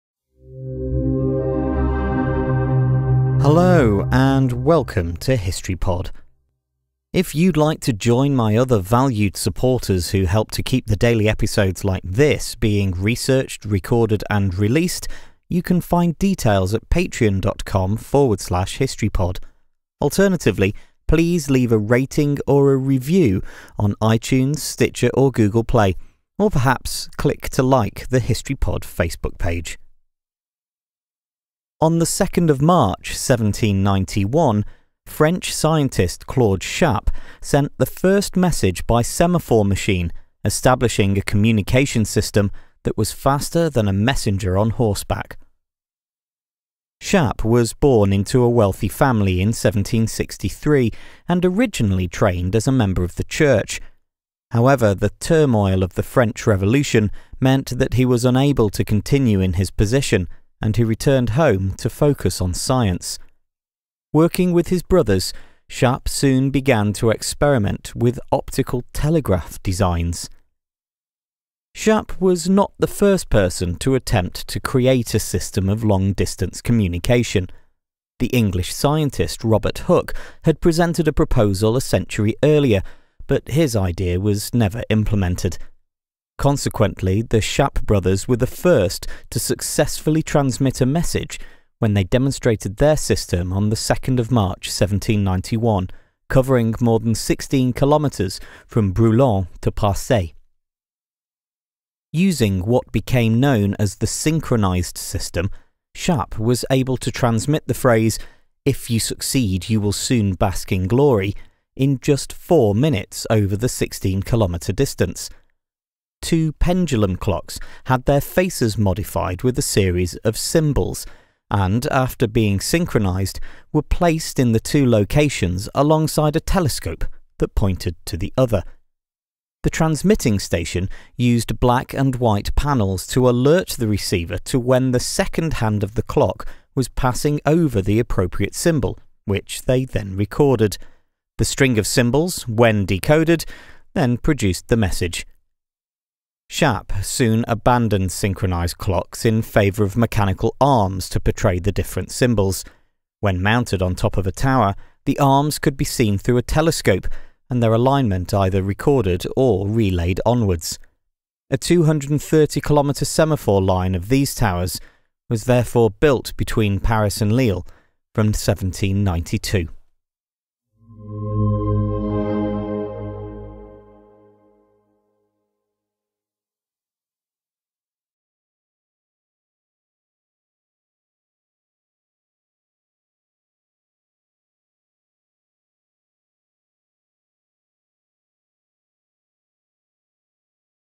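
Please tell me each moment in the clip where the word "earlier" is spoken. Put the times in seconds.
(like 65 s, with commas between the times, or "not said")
82 s.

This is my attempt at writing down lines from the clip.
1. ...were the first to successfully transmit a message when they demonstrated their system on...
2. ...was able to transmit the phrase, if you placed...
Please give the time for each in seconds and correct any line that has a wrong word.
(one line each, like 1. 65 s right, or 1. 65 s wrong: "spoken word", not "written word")
1. 88 s right
2. 106 s wrong: "succeed", not "placed".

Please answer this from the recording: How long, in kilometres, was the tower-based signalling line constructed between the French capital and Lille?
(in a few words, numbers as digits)
230 kilometres.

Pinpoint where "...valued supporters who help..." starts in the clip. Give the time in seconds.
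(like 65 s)
8 s.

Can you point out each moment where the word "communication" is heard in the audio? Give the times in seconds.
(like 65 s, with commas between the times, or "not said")
41 s, 76 s.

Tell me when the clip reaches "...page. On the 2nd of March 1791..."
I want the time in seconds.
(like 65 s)
29 s.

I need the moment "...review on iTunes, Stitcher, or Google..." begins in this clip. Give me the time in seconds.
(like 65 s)
22 s.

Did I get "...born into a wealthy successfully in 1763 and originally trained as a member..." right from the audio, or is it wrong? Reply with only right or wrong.
wrong.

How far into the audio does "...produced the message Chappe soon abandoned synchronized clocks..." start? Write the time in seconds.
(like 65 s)
144 s.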